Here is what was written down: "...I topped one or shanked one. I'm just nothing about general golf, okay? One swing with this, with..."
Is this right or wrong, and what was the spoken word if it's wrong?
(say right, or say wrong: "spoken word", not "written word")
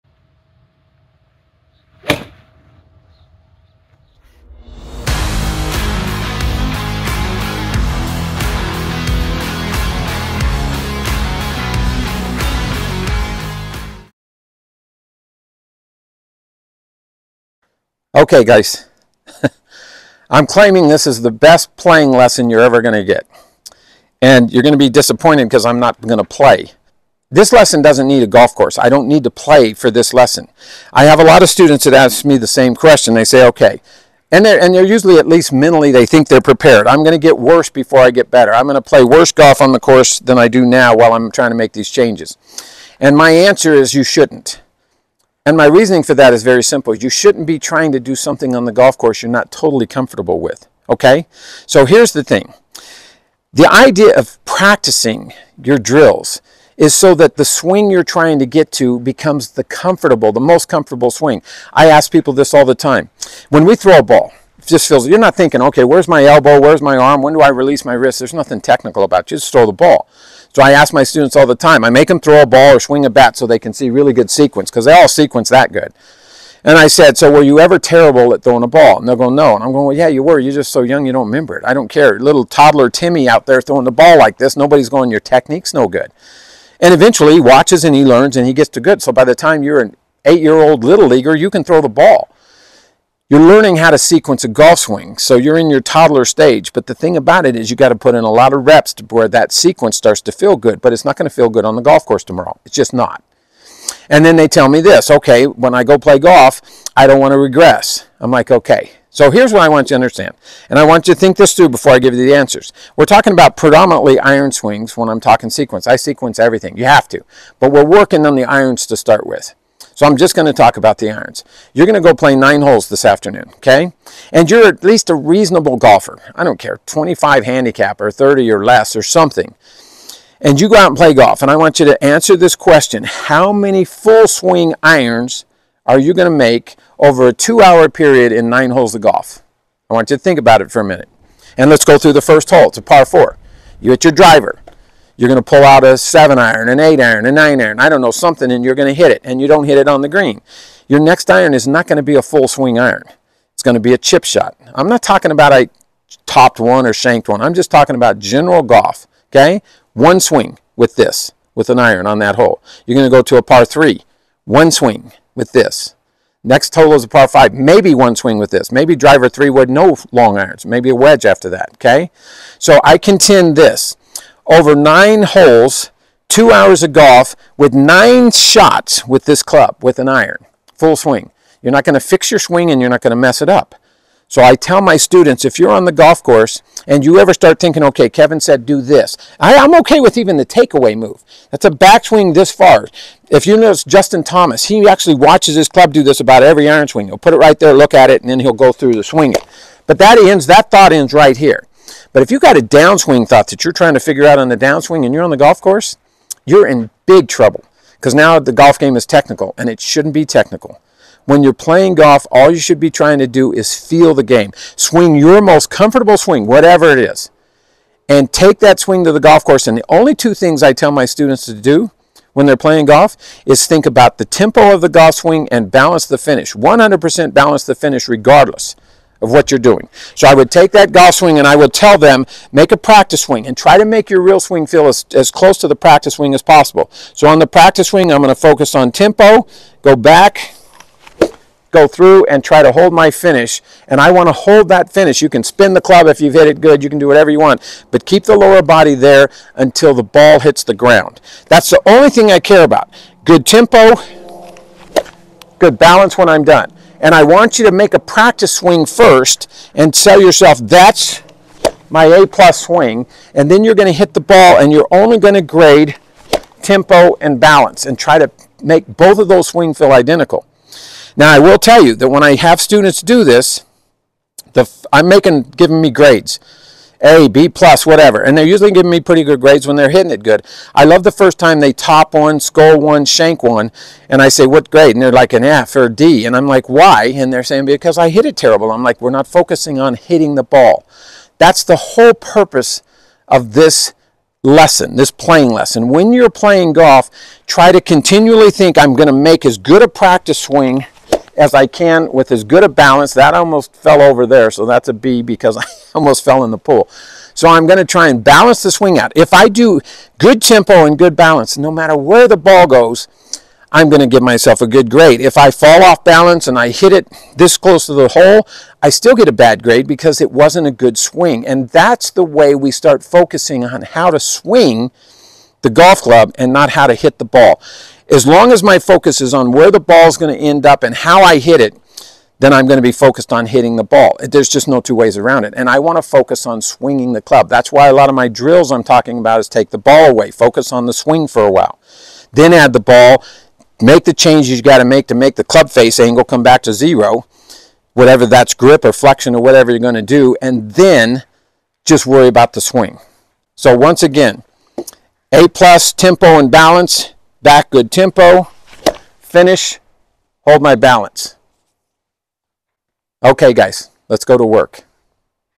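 wrong: "talking", not "nothing".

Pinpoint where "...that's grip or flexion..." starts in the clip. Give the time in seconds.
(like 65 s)
348 s.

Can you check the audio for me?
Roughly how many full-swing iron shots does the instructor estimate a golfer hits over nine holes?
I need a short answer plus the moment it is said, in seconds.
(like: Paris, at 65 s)
9, at 177 s.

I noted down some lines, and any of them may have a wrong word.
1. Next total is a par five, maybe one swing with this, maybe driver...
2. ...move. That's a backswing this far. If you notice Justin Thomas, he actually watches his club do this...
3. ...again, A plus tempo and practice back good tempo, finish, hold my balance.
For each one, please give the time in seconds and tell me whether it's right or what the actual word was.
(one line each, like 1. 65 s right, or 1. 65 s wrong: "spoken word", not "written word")
1. 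166 s right
2. 190 s right
3. 354 s wrong: "balance", not "practice".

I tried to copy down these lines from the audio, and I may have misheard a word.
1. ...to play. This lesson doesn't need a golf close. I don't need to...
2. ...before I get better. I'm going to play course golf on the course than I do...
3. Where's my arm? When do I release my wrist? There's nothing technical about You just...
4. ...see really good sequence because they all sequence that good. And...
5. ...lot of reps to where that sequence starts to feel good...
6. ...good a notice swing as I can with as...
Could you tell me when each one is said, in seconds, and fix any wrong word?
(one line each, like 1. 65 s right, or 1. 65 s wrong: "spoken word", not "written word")
1. 26 s wrong: "course", not "close"
2. 37 s wrong: "worse", not "course"
3. 66 s right
4. 73 s right
5. 98 s right
6. 299 s wrong: "practice", not "notice".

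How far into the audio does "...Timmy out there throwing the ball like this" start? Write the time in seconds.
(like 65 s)
82 s.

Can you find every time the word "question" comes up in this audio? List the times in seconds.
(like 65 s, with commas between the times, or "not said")
32 s, 132 s.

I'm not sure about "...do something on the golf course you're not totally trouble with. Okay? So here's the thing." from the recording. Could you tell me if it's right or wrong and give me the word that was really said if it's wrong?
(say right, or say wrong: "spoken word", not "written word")
wrong: "comfortable", not "trouble".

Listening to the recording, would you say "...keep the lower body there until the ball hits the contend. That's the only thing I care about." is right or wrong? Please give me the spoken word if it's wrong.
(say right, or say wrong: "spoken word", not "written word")
wrong: "ground", not "contend".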